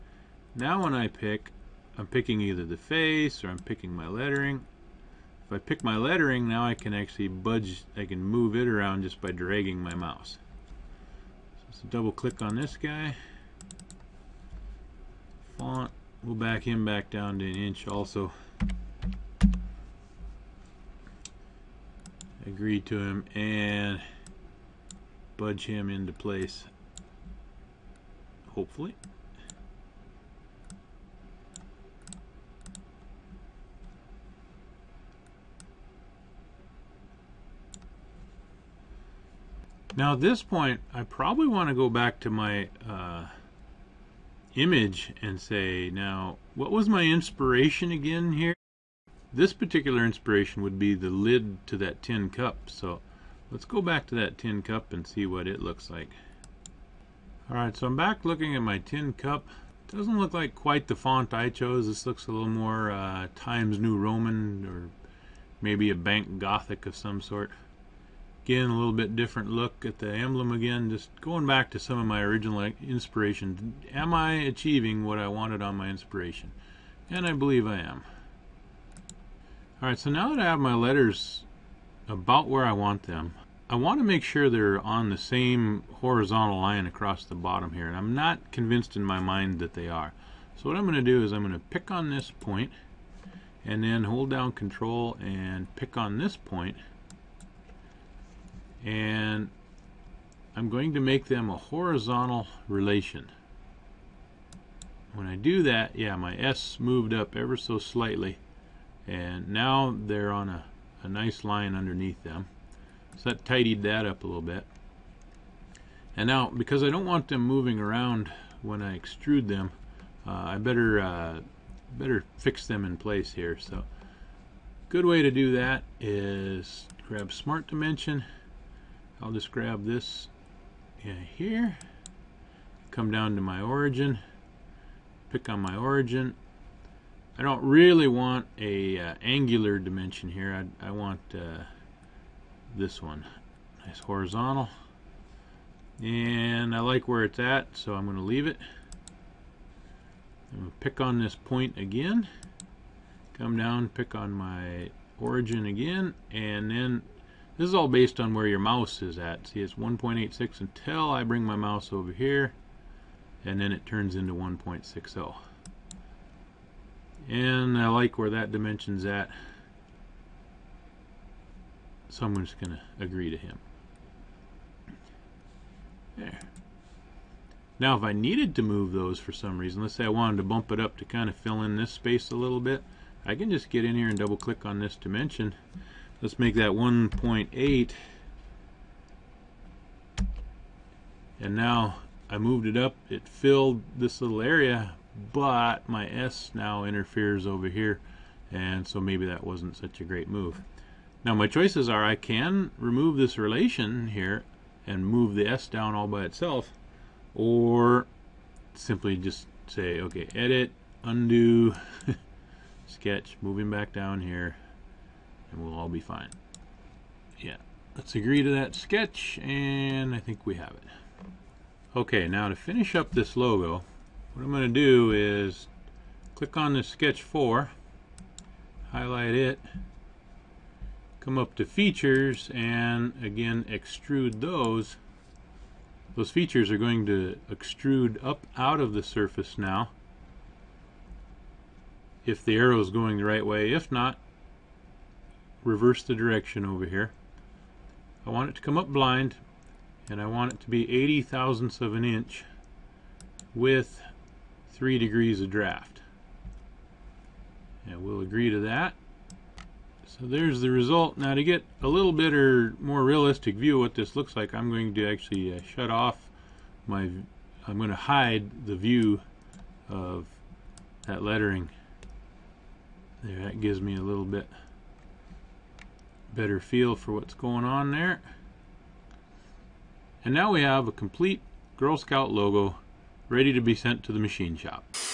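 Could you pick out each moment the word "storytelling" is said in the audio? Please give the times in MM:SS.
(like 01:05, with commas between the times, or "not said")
not said.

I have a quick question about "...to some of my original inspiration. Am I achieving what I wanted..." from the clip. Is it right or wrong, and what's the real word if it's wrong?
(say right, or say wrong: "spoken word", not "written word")
right.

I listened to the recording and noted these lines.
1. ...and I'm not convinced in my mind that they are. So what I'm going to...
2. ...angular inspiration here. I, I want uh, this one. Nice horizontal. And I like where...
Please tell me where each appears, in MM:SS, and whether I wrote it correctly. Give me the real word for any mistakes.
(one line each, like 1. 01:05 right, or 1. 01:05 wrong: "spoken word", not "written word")
1. 01:27 right
2. 02:19 wrong: "dimension", not "inspiration".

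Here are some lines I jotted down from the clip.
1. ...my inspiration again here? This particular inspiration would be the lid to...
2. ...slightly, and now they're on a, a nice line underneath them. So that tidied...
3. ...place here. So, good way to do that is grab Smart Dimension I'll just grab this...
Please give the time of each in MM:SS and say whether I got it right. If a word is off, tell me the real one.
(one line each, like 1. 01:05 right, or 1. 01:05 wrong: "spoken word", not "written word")
1. 00:46 right
2. 01:47 right
3. 02:02 right.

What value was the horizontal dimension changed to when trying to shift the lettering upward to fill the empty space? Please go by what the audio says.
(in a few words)
1.8.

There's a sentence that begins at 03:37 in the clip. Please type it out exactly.
Yeah, let's agree to that sketch, and I think we have it.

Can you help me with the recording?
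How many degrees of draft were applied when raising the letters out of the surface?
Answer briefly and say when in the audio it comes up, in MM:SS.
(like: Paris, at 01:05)
3, at 04:14.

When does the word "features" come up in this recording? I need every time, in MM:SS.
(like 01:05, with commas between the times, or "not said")
03:51, 03:56.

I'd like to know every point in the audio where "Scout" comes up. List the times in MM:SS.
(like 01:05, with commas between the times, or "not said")
04:41.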